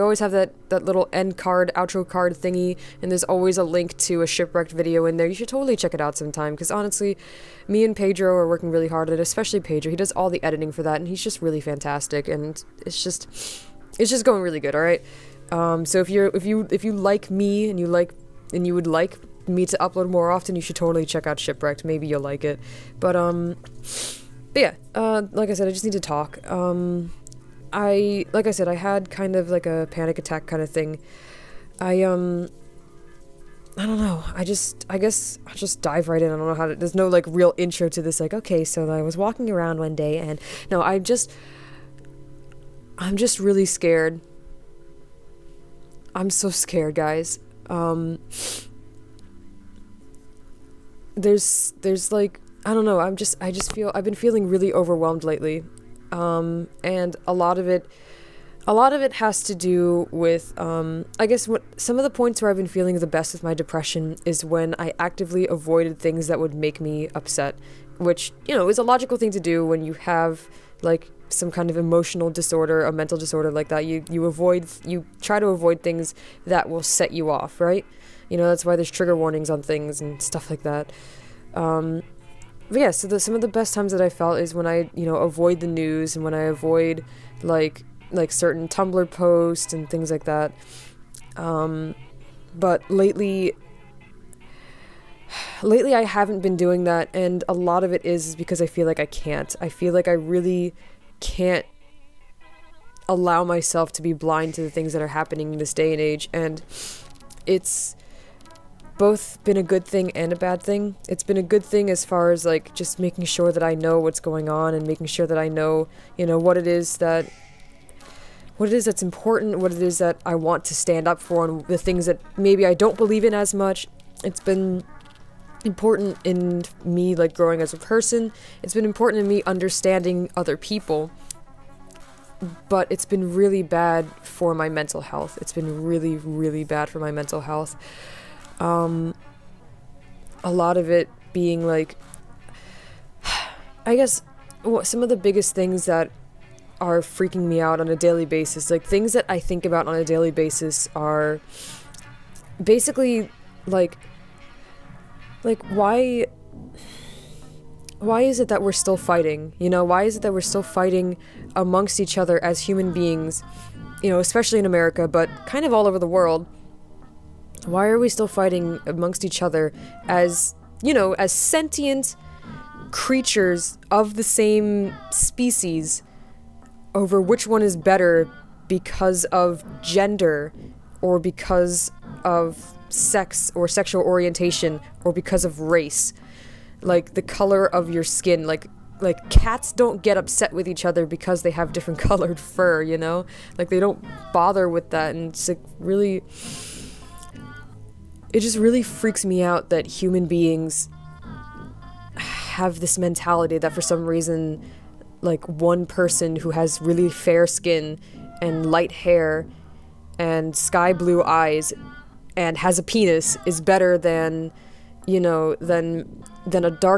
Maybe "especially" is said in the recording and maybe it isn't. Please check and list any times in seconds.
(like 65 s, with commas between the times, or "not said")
9 s, 164 s.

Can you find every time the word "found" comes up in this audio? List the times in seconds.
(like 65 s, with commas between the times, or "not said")
not said.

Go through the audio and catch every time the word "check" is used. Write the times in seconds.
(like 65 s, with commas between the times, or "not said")
5 s, 21 s.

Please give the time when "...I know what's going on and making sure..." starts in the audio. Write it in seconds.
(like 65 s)
113 s.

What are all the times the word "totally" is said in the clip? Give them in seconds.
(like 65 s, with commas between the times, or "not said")
5 s, 20 s.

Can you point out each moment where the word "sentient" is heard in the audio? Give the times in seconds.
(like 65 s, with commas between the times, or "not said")
171 s.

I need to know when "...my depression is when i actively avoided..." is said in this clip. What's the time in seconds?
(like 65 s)
63 s.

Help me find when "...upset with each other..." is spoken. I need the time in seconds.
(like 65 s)
190 s.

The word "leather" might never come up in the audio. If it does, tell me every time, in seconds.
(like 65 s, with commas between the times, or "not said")
not said.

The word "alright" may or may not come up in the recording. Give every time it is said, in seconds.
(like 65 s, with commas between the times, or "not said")
14 s.